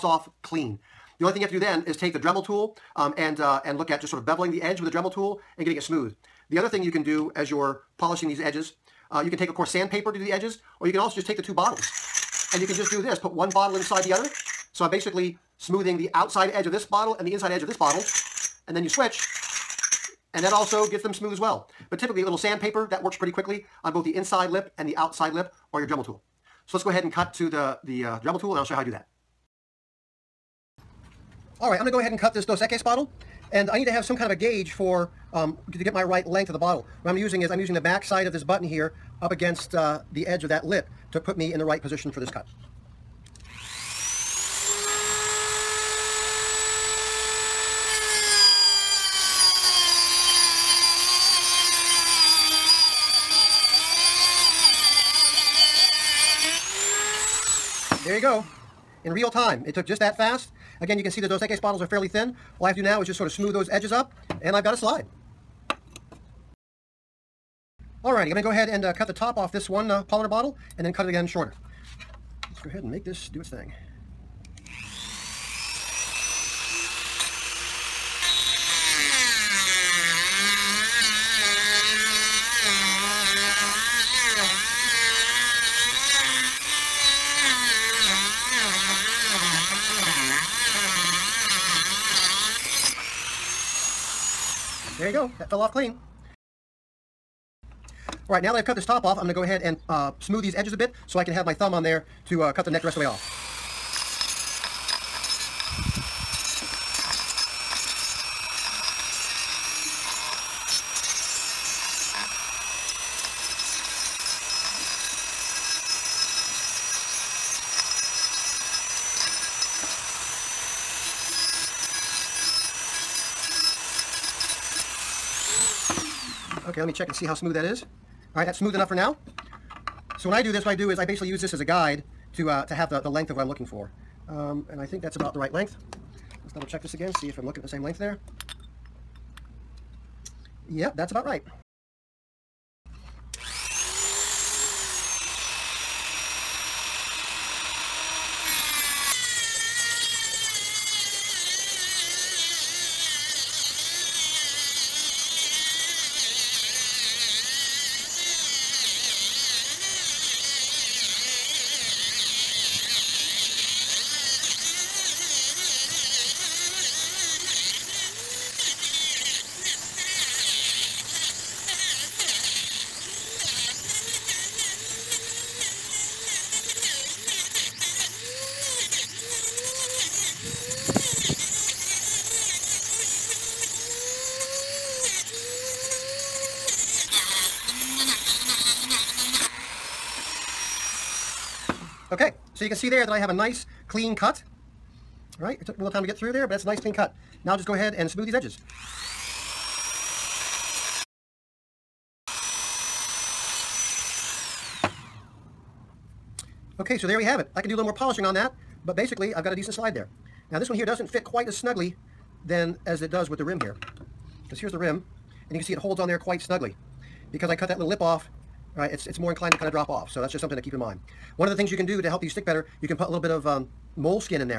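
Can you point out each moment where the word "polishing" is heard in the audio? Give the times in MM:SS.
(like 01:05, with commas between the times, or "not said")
00:07, 03:27.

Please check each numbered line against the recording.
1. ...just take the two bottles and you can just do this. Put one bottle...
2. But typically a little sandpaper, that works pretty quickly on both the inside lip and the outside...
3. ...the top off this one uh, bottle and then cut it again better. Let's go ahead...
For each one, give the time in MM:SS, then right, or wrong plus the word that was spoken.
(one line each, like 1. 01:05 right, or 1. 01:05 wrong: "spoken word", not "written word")
1. 00:11 right
2. 00:21 right
3. 01:09 wrong: "shorter", not "better".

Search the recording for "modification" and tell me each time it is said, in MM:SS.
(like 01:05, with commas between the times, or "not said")
not said.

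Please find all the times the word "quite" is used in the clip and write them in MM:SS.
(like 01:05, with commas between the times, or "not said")
03:31, 03:36.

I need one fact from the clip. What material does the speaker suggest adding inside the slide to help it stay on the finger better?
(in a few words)
moleskin.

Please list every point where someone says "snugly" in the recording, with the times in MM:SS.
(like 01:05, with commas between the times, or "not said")
03:31, 03:36.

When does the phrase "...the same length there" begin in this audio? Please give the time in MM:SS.
02:17.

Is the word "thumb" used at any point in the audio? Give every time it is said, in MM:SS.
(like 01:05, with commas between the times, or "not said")
01:41.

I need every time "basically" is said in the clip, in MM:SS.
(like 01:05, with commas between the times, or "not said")
00:14, 02:11, 03:28.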